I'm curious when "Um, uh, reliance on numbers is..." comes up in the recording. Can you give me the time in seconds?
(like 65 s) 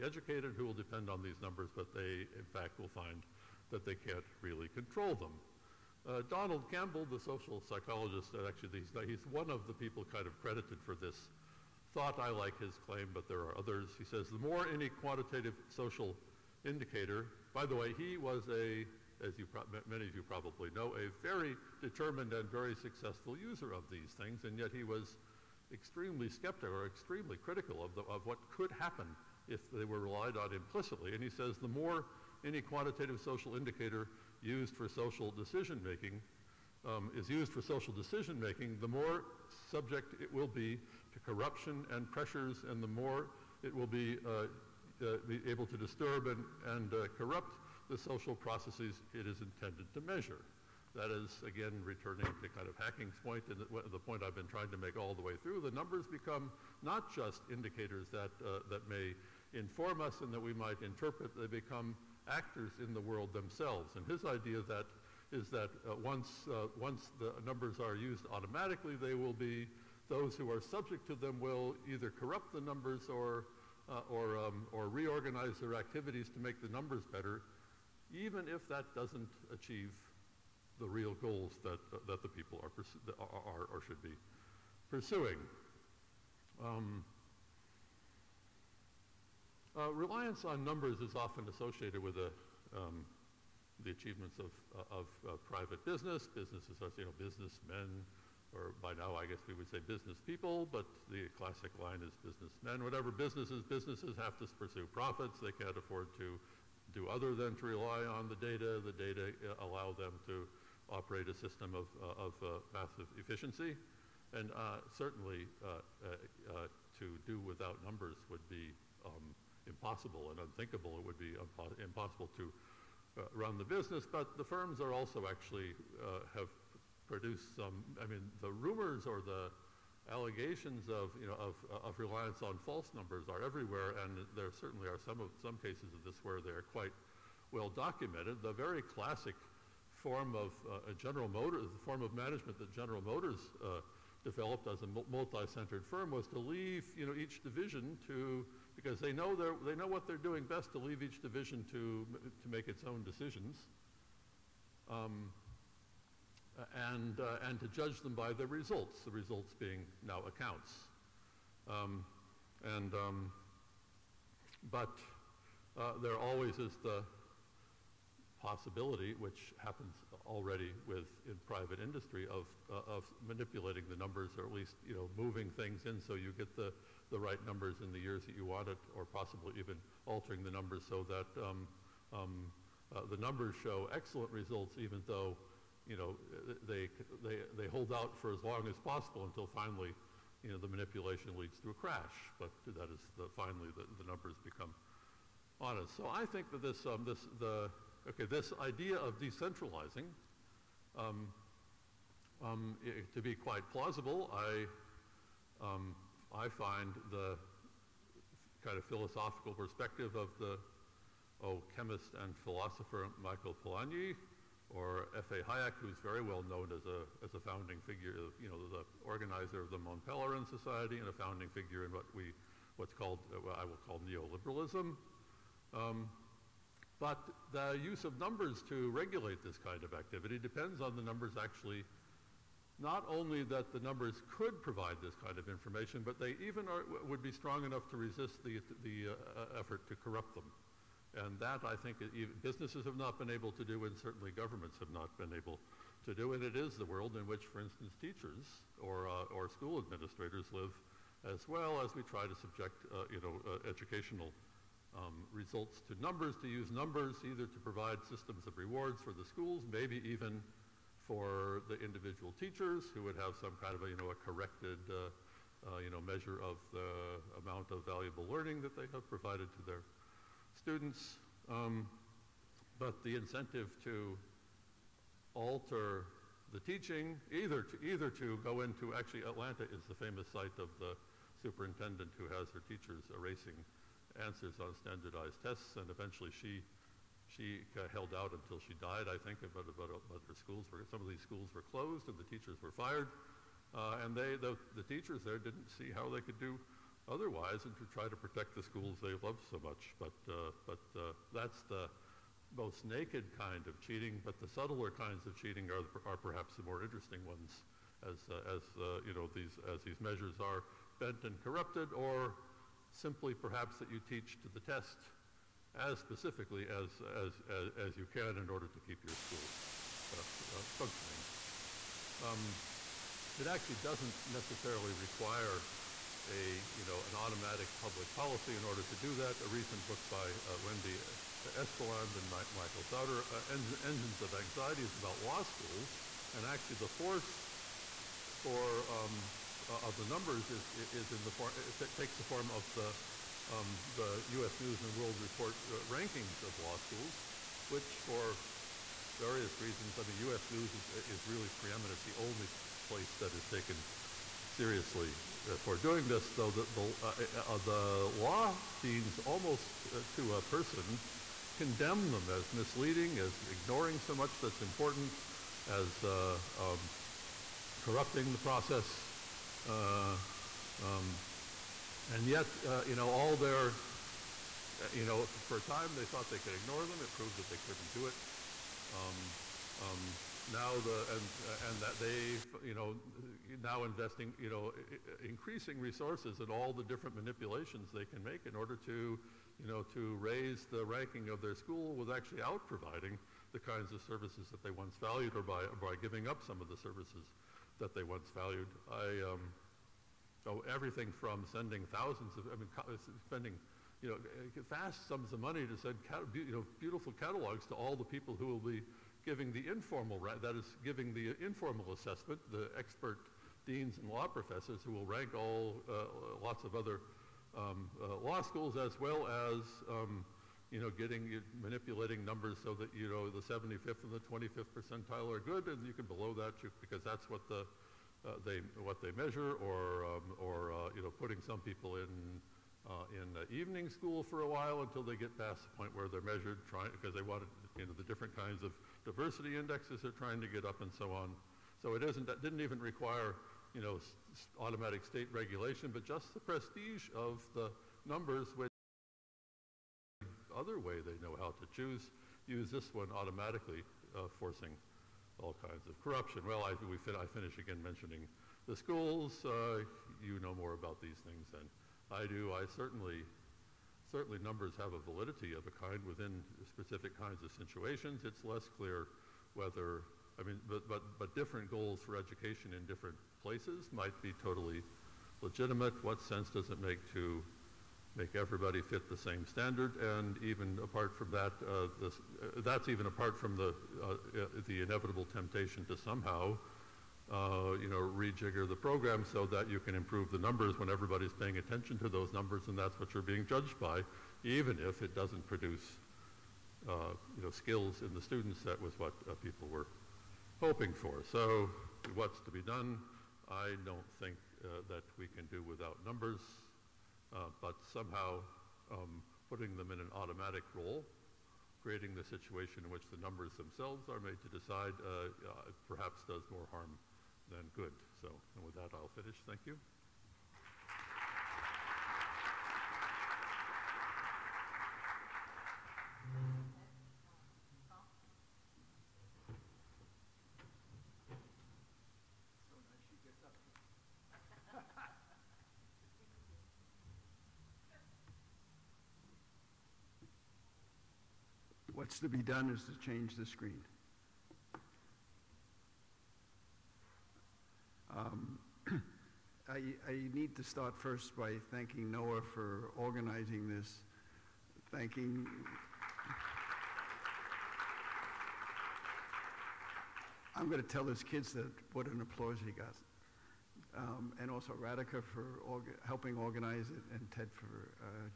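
86 s.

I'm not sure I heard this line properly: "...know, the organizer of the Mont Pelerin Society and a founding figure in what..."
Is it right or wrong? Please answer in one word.
right.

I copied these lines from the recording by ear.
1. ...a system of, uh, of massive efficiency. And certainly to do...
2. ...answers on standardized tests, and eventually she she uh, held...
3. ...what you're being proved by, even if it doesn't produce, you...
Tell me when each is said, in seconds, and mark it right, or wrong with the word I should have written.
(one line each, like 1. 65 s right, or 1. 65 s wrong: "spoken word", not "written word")
1. 111 s right
2. 284 s right
3. 492 s wrong: "judged", not "proved".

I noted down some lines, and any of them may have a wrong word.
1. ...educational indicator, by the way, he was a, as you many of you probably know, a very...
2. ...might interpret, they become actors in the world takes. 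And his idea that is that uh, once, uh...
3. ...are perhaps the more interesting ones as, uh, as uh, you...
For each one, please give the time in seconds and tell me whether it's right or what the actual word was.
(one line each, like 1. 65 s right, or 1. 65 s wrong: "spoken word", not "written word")
1. 15 s wrong: "social", not "educational"
2. 60 s wrong: "themselves", not "takes"
3. 306 s right.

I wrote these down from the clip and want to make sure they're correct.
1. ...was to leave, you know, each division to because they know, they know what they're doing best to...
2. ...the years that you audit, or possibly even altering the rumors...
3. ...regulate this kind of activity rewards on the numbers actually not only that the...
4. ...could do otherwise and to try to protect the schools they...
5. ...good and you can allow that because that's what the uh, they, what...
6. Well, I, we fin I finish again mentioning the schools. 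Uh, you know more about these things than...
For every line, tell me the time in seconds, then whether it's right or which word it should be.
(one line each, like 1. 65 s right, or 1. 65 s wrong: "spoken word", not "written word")
1. 146 s right
2. 177 s wrong: "numbers", not "rumors"
3. 228 s wrong: "depends", not "rewards"
4. 296 s right
5. 425 s wrong: "below", not "allow"
6. 456 s right.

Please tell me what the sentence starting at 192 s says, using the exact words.
But that is the, finally the, the numbers become honest.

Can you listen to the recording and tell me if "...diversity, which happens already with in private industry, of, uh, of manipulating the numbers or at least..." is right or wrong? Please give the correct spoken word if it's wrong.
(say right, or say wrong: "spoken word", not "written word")
wrong: "possibility", not "diversity".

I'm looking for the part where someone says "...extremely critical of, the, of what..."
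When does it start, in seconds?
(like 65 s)
26 s.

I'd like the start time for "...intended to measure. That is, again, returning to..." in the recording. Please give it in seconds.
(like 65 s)
49 s.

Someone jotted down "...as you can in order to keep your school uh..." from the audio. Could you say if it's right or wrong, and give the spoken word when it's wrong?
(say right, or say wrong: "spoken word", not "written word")
right.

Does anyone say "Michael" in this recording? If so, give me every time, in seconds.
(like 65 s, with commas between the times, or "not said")
213 s, 332 s.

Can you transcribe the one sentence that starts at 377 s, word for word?
It proved that they couldn't do it.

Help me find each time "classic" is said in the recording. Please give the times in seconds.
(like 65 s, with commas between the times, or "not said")
101 s, 138 s.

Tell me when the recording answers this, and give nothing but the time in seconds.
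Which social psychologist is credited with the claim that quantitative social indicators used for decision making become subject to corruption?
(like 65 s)
6 s.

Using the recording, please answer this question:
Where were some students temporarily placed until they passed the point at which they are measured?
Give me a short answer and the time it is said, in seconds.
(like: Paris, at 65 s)
evening school, at 433 s.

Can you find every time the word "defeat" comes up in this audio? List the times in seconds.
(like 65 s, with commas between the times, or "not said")
not said.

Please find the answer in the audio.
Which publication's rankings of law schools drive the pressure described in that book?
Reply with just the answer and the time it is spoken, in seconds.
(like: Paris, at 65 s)
U.S. News and World Report, at 344 s.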